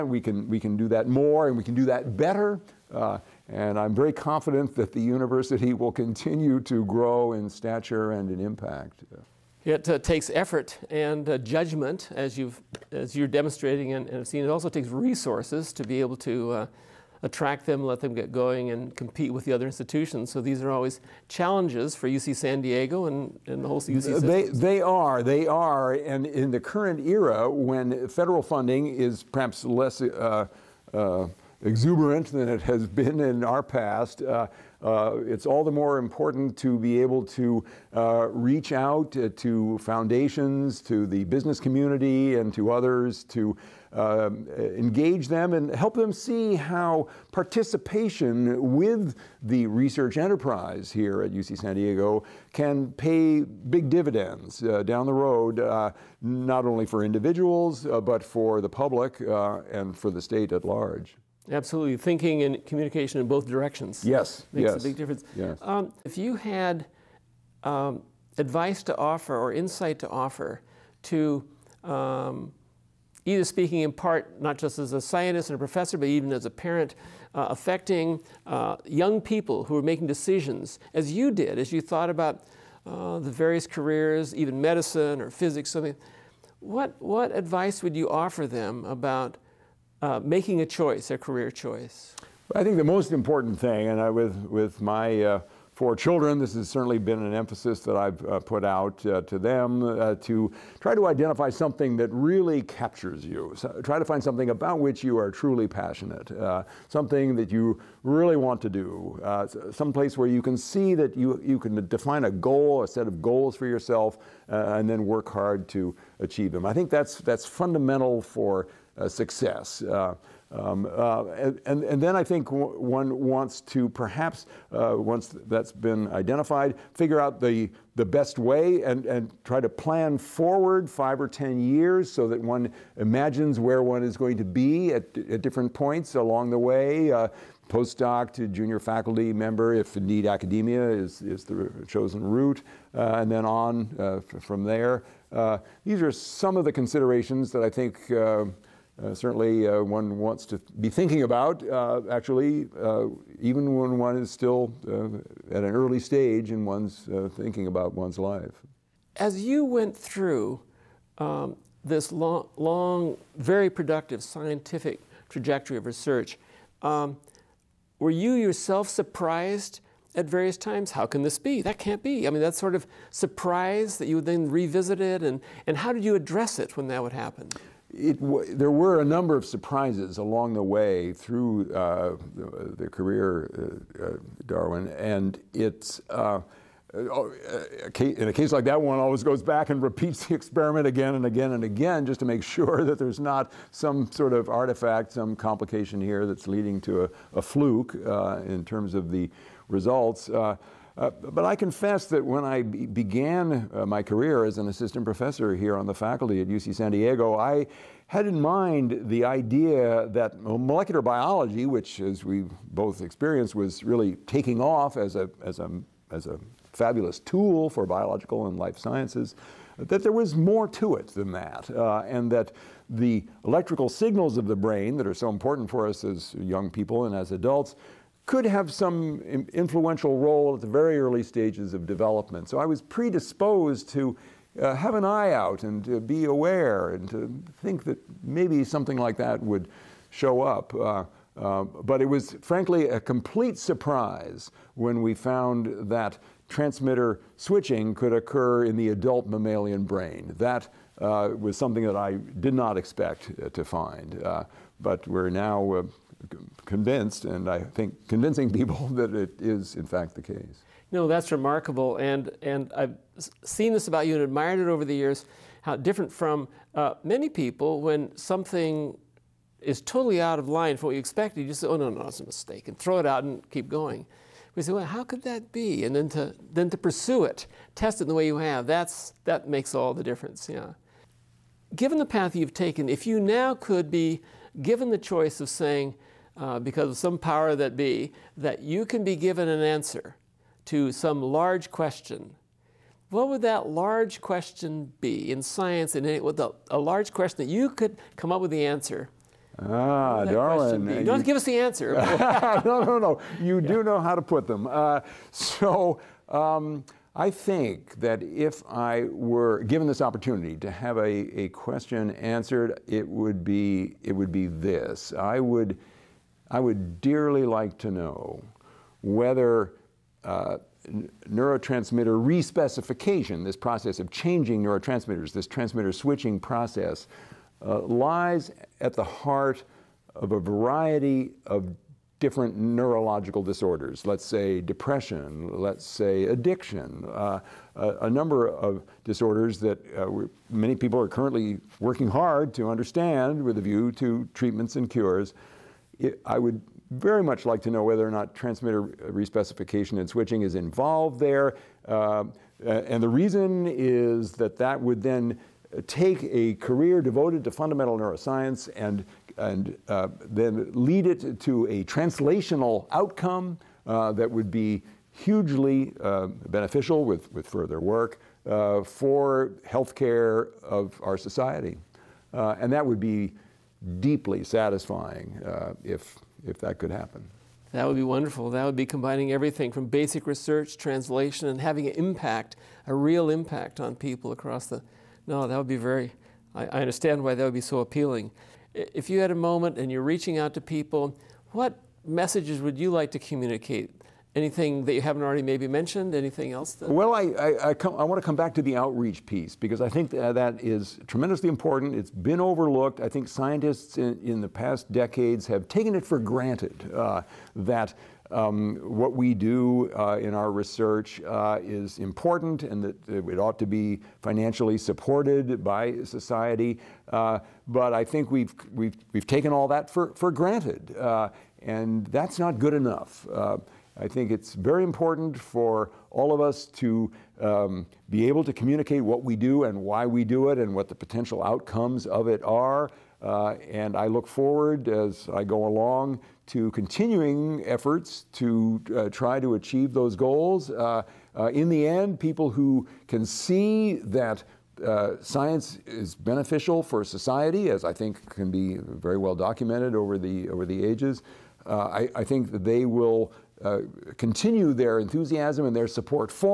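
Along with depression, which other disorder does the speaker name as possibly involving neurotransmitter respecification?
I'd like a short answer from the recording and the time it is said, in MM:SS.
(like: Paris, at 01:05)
addiction, at 05:36.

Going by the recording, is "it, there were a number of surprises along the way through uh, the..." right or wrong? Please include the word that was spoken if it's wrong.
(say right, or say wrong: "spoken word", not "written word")
right.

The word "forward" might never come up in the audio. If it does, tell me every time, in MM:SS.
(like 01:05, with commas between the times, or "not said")
02:10, 07:14.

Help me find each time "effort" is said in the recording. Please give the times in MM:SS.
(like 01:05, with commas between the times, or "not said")
00:10, 07:17.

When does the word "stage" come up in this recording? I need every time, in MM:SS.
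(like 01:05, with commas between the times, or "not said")
02:35, 03:51.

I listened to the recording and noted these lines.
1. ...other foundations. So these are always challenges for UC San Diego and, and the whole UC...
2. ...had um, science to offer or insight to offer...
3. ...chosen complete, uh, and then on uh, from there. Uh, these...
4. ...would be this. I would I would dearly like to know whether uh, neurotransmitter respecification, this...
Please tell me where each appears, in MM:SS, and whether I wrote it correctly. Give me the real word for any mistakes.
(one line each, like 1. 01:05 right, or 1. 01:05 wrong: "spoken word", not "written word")
1. 00:19 wrong: "institutions", not "foundations"
2. 01:06 wrong: "advice", not "science"
3. 02:21 wrong: "route", not "complete"
4. 05:14 right.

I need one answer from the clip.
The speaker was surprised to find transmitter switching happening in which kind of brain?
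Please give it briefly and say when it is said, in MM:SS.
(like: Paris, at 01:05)
adult mammalian brain, at 04:08.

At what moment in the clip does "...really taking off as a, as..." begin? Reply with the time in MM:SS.
03:33.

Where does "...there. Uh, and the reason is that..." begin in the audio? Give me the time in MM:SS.
05:51.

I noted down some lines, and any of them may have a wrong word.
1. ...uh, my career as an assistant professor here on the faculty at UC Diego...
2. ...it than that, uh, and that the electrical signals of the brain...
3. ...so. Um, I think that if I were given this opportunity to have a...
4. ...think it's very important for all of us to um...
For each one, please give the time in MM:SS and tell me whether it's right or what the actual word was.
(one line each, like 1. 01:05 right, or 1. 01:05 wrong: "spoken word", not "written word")
1. 03:23 wrong: "San", not "Diego"
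2. 03:40 right
3. 05:05 right
4. 07:04 right.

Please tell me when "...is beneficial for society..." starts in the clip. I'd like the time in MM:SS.
07:25.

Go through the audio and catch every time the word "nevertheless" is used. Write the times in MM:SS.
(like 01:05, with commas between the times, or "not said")
not said.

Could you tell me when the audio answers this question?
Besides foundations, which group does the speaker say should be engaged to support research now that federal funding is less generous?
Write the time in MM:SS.
00:41.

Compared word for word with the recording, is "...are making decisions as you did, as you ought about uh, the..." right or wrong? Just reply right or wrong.
wrong.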